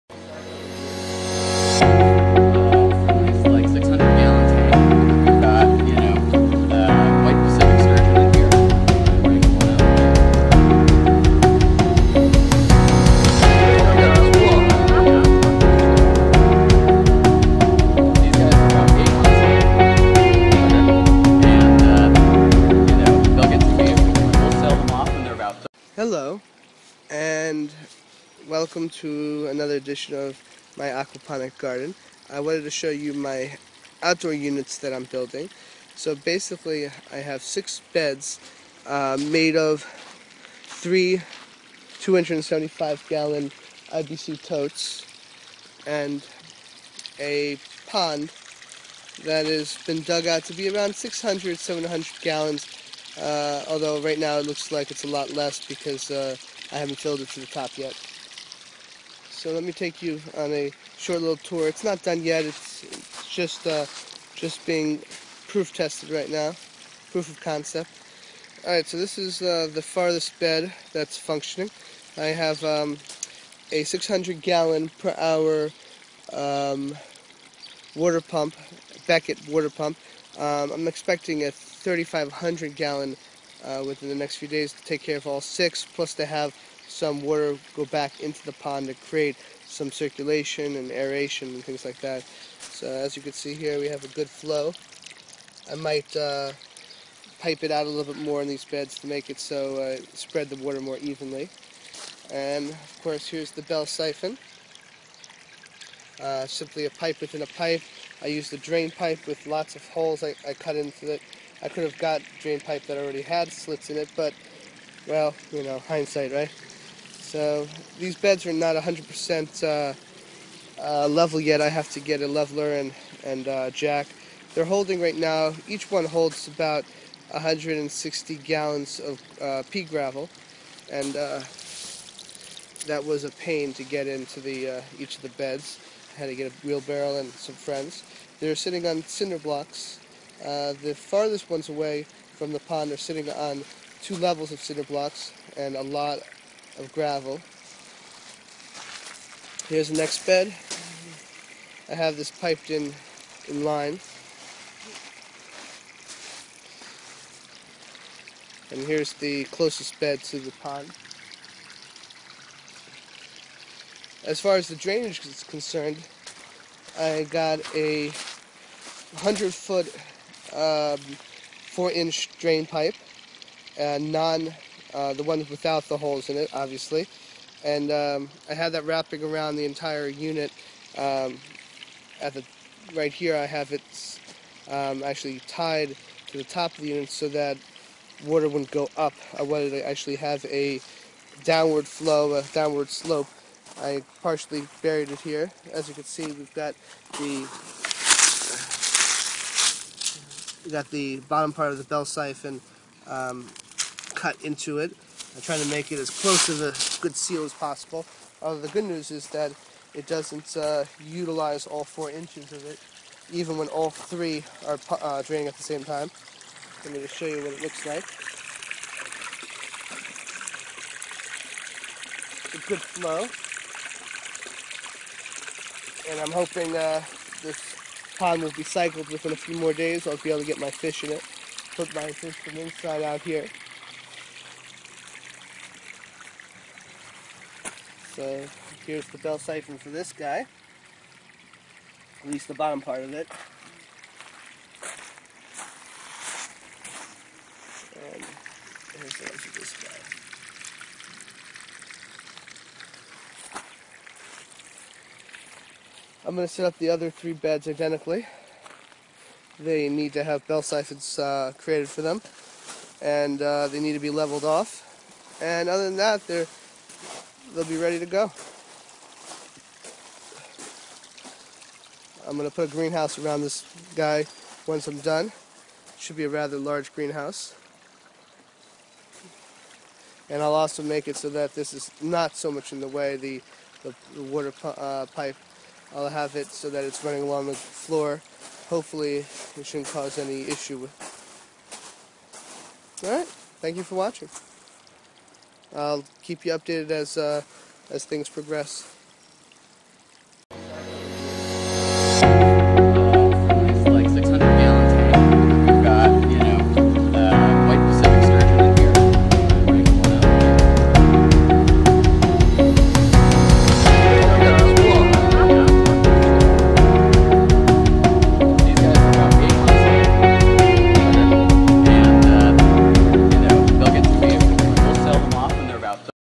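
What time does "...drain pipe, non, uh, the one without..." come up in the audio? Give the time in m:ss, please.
2:52.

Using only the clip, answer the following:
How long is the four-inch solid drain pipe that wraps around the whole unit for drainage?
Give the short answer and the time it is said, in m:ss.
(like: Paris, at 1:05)
100 foot, at 2:48.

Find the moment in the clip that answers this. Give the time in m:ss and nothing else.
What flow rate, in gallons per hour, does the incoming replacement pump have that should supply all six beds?
1:21.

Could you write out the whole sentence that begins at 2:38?
And here's the closest bed to the pond.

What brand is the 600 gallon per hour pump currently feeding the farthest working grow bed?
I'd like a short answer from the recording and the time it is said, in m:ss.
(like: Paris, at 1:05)
Beckett, at 1:19.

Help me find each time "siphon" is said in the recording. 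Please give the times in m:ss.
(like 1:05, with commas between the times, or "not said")
1:43, 3:22, 3:59, 4:20.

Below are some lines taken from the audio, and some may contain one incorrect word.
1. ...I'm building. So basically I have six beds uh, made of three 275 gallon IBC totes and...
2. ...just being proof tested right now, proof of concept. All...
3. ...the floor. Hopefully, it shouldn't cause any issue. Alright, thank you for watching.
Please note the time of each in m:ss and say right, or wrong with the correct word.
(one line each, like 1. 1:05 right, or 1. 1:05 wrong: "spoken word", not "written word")
1. 0:34 right
2. 1:04 right
3. 4:47 right.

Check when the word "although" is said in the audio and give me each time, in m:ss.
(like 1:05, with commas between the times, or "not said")
0:53, 3:28.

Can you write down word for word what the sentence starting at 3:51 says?
Put my fish from inside out here.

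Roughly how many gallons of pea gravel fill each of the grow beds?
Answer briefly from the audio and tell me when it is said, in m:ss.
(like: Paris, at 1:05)
160 gallons, at 2:07.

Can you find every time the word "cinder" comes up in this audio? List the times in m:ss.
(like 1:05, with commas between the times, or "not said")
2:19, 2:24.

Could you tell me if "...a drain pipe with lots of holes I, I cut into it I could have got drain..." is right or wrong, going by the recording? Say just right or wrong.
right.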